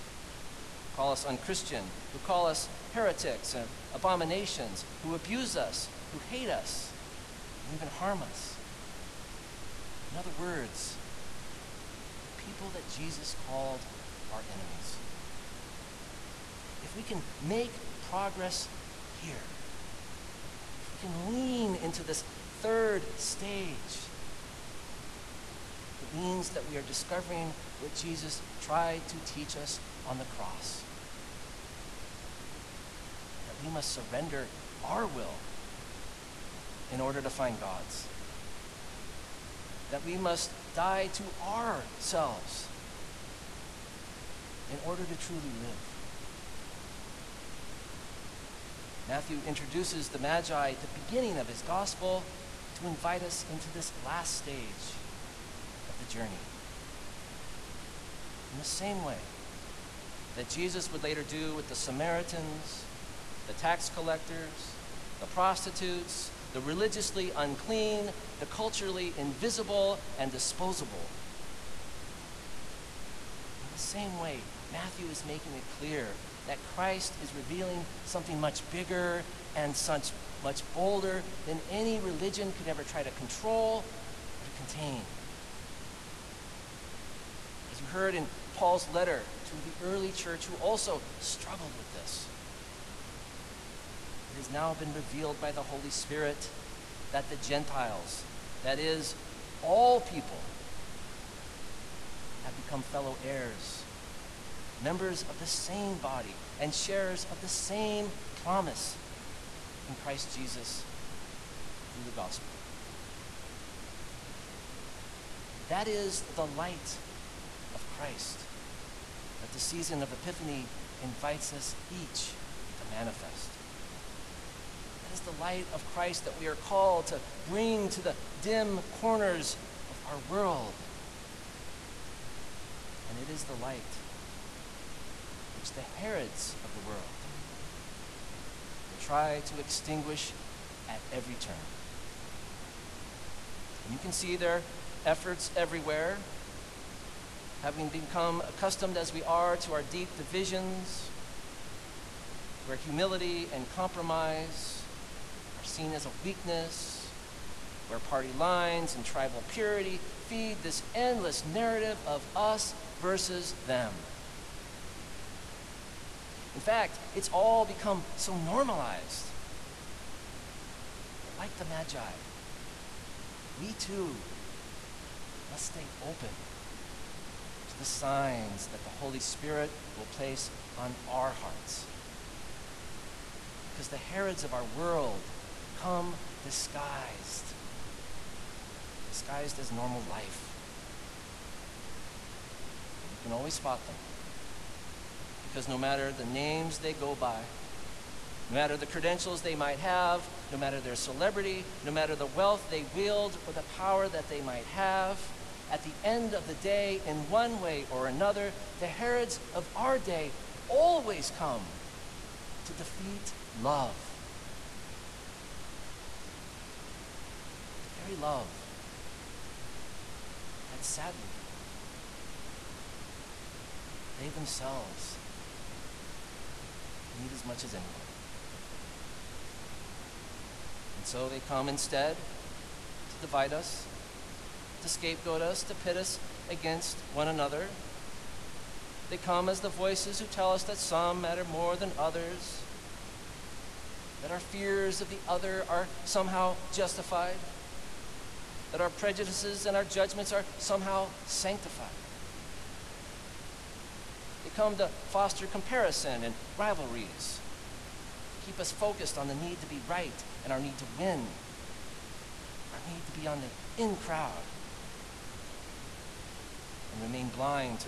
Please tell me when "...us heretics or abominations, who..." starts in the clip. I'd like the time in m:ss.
0:02.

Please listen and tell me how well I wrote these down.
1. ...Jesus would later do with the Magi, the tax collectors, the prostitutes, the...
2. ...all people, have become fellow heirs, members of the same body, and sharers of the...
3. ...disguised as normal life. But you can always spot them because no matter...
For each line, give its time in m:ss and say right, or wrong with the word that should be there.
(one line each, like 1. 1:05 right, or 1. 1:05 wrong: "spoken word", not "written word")
1. 1:00 wrong: "Samaritans", not "Magi"
2. 1:39 right
3. 3:09 right.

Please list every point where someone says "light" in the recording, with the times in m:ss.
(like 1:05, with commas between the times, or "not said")
1:56, 2:05, 2:13.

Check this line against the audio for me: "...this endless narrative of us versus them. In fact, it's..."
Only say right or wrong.
right.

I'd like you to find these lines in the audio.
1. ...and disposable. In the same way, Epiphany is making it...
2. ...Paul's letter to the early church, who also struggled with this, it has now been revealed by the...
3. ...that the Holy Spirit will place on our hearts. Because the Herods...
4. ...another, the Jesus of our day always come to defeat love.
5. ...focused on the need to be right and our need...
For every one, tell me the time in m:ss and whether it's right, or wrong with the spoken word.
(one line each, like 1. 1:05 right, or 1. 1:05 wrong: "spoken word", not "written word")
1. 1:10 wrong: "Matthew", not "Epiphany"
2. 1:28 right
3. 2:58 right
4. 3:28 wrong: "Herods", not "Jesus"
5. 4:18 right.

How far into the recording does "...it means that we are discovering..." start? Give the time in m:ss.
0:25.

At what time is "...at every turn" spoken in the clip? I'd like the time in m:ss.
2:20.